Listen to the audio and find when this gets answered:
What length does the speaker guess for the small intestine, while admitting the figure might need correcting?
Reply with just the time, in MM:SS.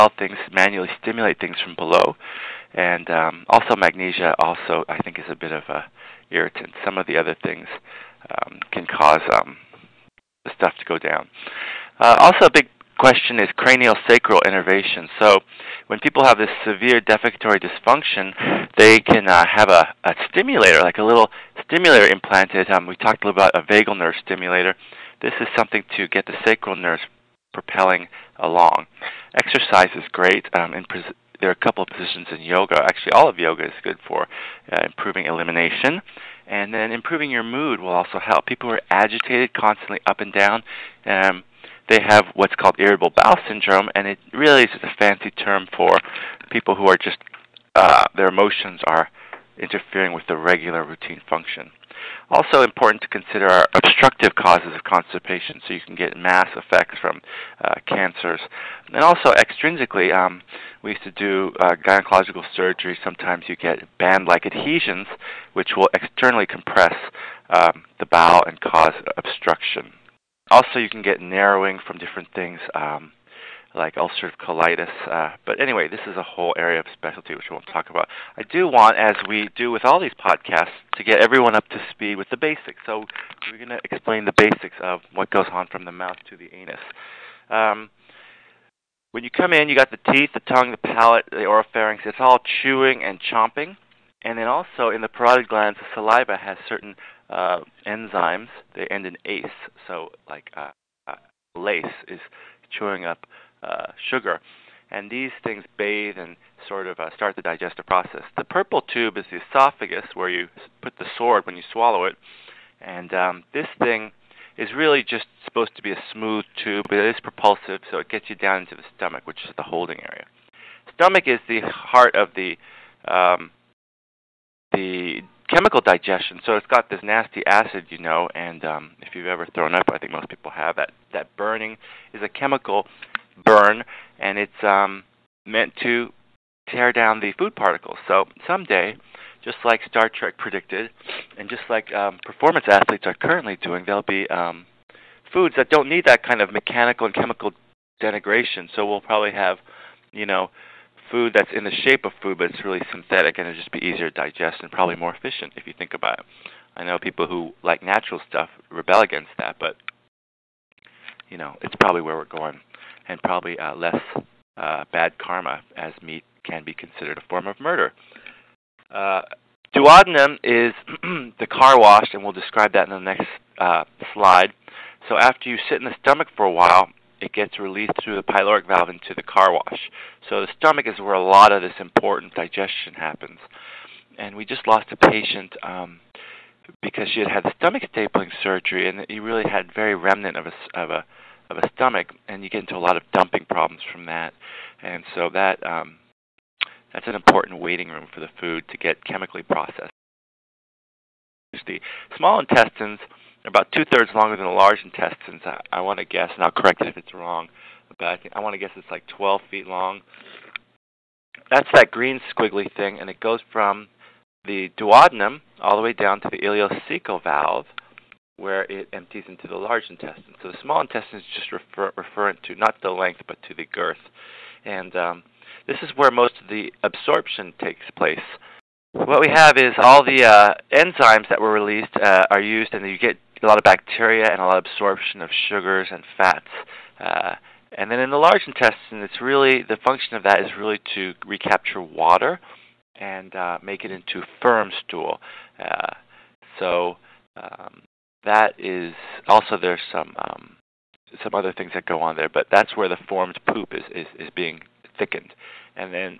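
03:29.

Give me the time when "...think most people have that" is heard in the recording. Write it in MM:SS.
02:09.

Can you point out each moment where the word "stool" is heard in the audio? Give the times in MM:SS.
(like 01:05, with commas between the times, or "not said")
04:04.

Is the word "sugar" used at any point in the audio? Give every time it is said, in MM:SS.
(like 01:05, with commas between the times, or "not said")
01:44, 03:55.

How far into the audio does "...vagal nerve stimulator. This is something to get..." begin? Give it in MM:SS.
00:23.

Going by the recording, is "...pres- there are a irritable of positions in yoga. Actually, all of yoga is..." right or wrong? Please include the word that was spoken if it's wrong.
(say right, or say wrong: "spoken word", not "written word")
wrong: "couple", not "irritable".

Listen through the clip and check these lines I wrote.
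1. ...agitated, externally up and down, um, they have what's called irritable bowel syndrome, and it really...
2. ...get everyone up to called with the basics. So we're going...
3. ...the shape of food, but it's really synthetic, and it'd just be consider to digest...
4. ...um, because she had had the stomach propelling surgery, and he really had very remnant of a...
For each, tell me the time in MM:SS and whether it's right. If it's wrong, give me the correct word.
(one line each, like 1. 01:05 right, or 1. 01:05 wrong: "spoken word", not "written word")
1. 00:38 wrong: "constantly", not "externally"
2. 01:21 wrong: "speed", not "called"
3. 02:31 wrong: "easier", not "consider"
4. 03:05 wrong: "stapling", not "propelling".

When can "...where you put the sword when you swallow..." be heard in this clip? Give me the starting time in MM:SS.
01:50.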